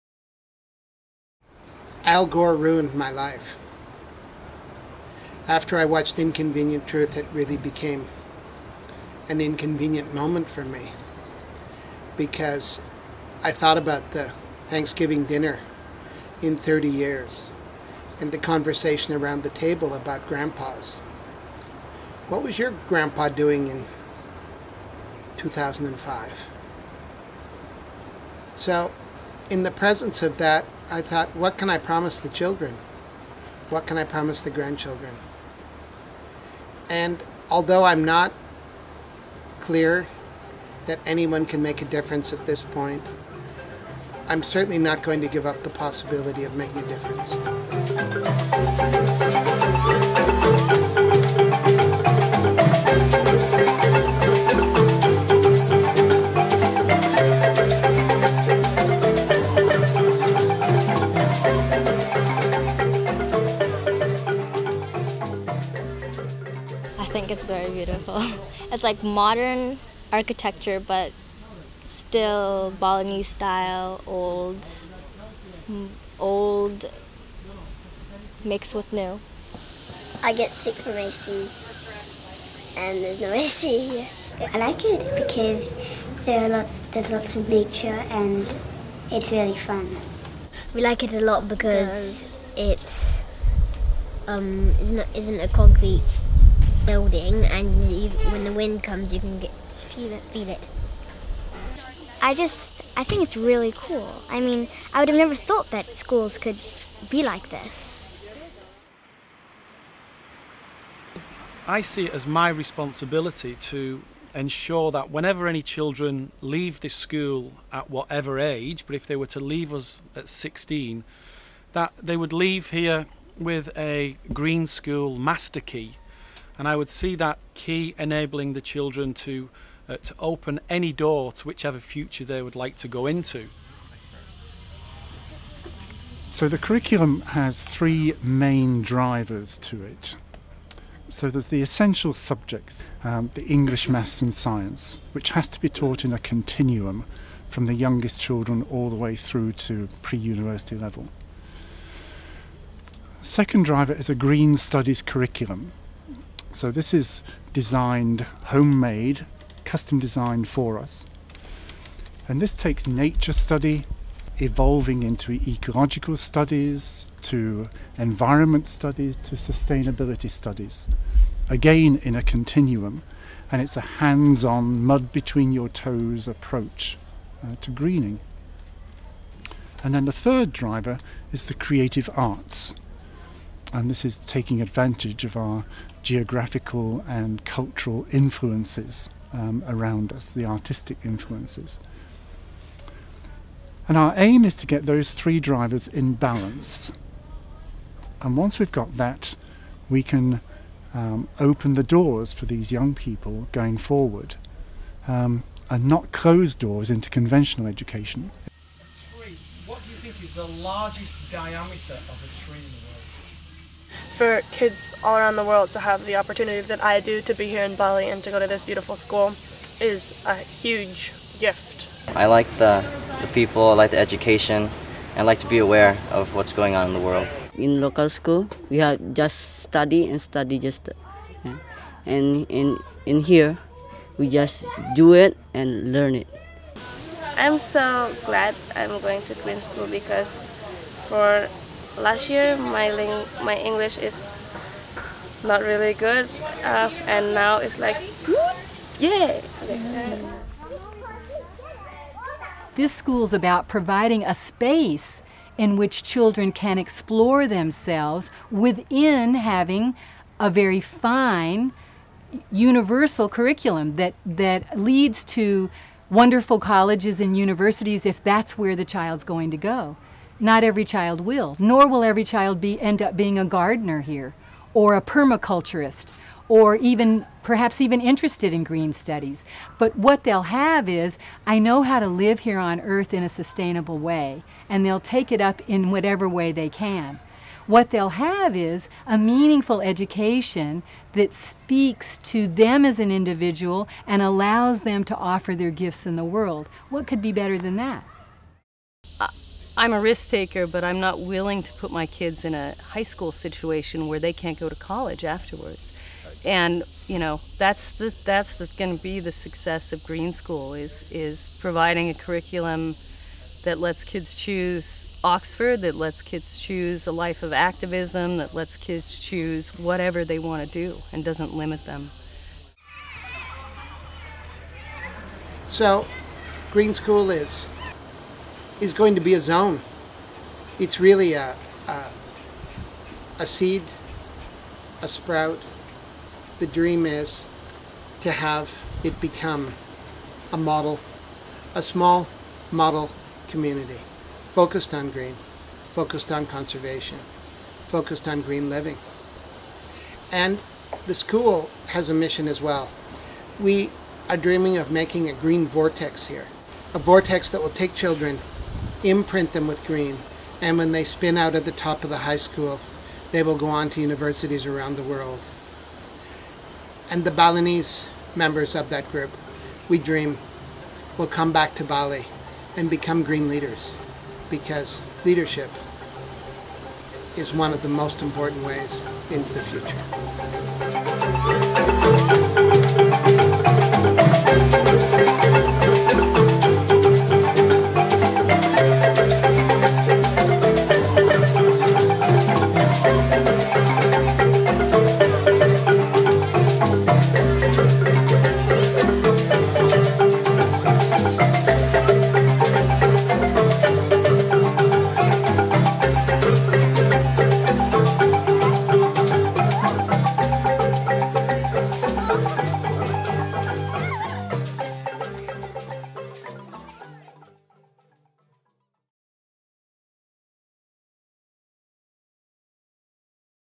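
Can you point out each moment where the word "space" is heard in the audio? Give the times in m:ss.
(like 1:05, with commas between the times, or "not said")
4:14.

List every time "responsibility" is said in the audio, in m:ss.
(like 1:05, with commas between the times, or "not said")
1:52.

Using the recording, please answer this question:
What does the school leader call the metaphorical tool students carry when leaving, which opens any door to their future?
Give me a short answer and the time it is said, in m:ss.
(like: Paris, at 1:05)
green school master key, at 2:04.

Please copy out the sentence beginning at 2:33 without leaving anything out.
Second driver is a green studies curriculum, so this is designed, homemade, custom designed for us.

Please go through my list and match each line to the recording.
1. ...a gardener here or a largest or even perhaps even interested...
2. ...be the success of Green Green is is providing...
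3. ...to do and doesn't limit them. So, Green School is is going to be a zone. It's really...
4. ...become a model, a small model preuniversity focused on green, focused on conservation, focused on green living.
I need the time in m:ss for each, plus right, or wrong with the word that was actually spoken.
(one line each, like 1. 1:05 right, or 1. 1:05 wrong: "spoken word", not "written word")
1. 4:33 wrong: "permaculturist", not "largest"
2. 5:09 wrong: "School", not "Green"
3. 5:20 right
4. 5:39 wrong: "community", not "preuniversity".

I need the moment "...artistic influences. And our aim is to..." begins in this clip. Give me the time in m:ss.
3:10.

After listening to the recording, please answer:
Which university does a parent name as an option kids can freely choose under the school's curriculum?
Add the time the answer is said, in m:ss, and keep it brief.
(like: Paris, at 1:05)
Oxford, at 5:15.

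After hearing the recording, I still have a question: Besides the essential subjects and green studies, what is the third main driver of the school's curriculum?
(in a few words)
creative arts.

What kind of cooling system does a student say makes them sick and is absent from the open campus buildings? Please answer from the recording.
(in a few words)
AC.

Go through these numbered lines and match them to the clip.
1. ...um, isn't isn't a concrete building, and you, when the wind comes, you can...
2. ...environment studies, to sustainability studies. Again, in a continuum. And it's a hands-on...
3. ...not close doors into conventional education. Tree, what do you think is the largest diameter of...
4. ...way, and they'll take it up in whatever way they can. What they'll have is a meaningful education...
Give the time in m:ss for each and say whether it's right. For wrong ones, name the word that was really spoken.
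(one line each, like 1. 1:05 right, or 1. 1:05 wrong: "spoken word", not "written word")
1. 1:34 right
2. 2:47 right
3. 3:25 right
4. 4:43 right.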